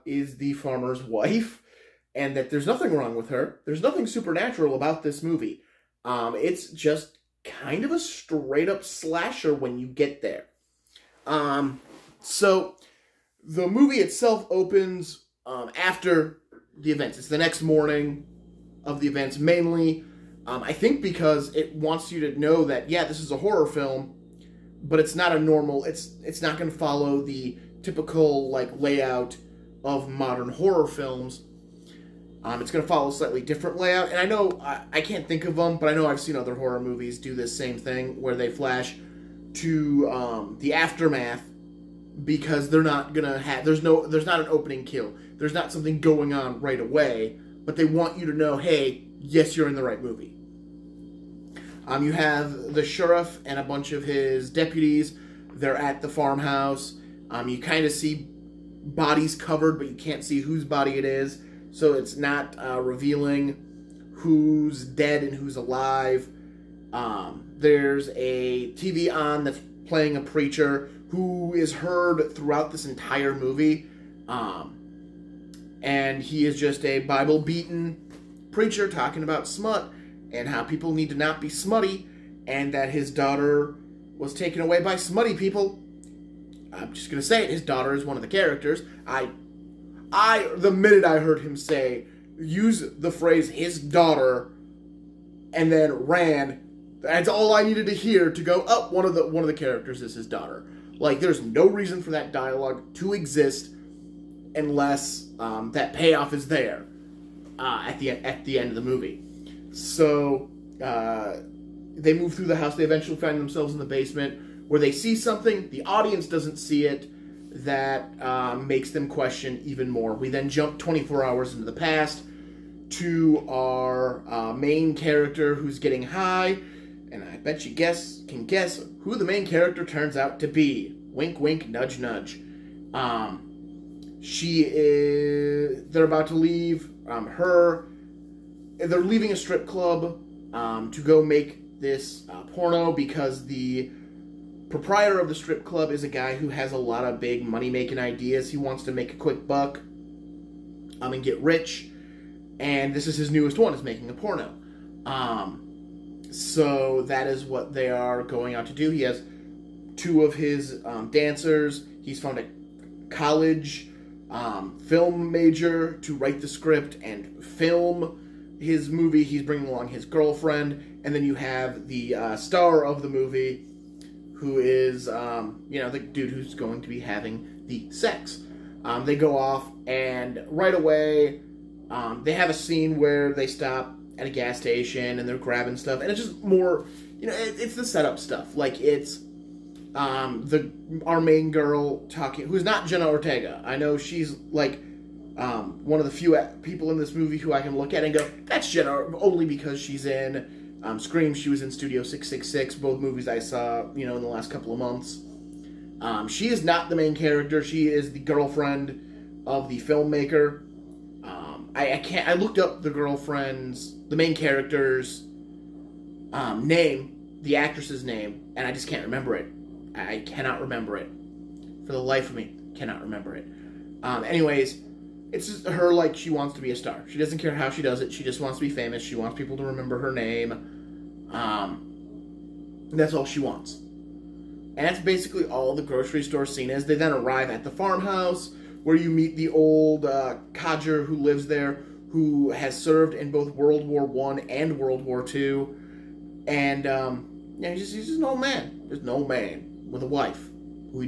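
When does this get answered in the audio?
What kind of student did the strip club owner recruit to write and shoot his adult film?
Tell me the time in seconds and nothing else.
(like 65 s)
164 s.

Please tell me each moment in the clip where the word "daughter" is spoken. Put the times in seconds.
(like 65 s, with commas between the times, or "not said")
83 s, 87 s, 93 s, 100 s.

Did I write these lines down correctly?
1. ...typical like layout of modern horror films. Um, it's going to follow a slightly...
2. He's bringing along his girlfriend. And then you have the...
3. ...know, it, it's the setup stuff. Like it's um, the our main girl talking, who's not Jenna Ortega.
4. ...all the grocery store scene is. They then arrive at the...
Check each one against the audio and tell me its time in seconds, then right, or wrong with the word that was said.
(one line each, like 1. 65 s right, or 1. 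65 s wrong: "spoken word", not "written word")
1. 27 s right
2. 169 s right
3. 187 s right
4. 235 s right.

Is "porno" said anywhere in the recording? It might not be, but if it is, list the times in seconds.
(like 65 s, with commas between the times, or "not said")
142 s, 154 s.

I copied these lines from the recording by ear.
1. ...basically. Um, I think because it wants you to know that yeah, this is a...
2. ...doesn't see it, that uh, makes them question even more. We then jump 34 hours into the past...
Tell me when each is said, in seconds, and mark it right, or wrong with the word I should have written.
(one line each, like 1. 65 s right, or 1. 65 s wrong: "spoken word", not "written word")
1. 19 s wrong: "mainly", not "basically"
2. 116 s wrong: "24", not "34".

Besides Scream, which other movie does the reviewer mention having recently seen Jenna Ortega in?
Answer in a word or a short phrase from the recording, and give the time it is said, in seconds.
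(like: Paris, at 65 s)
Studio 666, at 201 s.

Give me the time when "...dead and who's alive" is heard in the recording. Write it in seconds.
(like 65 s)
64 s.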